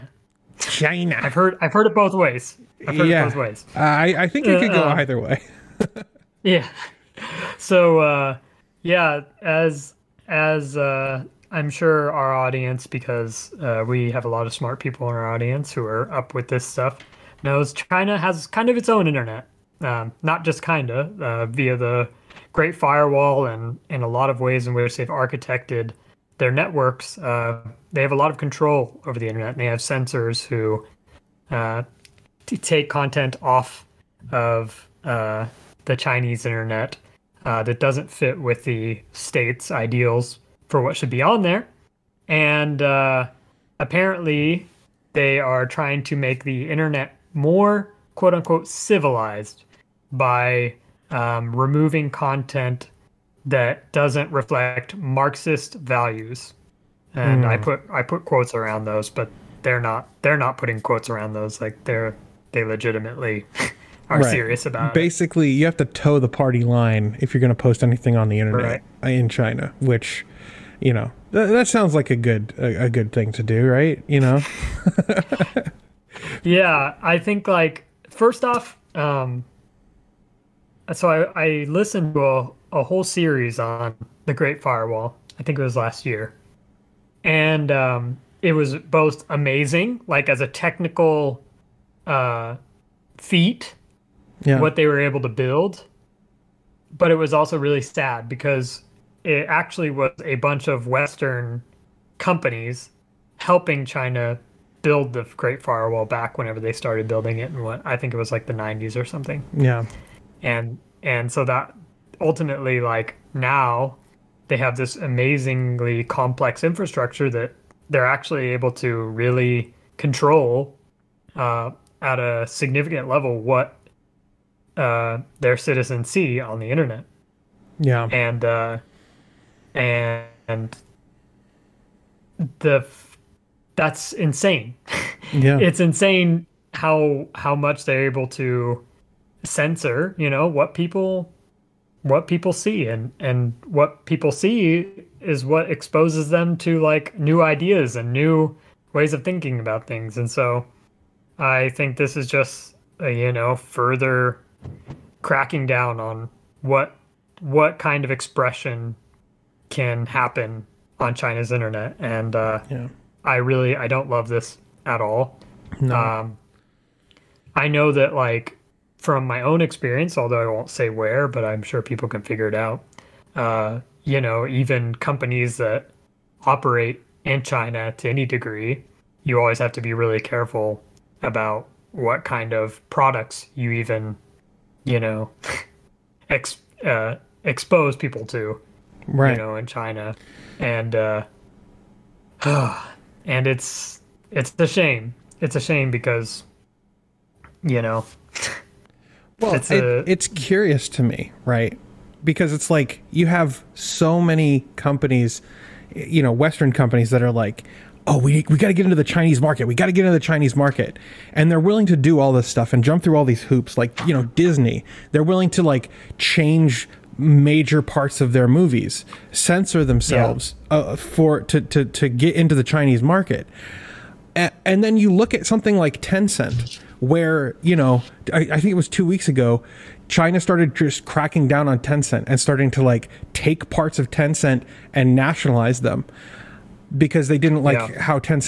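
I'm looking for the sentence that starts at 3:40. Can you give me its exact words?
uh, for to, to to get into the Chinese market.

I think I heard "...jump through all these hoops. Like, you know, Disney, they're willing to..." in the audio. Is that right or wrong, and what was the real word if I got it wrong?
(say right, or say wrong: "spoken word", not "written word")
right.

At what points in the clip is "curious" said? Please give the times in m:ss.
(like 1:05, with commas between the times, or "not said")
3:20.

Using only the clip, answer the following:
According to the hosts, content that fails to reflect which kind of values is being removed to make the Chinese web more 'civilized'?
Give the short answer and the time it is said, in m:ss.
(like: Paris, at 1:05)
Marxist values, at 0:54.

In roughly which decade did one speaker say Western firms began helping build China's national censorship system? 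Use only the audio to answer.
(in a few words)
the 90s.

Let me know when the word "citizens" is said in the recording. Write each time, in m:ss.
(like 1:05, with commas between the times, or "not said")
2:05.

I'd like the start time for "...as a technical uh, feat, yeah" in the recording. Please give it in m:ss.
1:30.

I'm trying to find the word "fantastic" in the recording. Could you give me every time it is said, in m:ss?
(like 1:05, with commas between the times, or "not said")
not said.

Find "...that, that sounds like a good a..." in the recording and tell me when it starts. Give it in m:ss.
1:11.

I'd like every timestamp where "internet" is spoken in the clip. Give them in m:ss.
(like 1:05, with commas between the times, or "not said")
0:19, 0:29, 0:36, 0:46, 1:08, 2:06, 2:41.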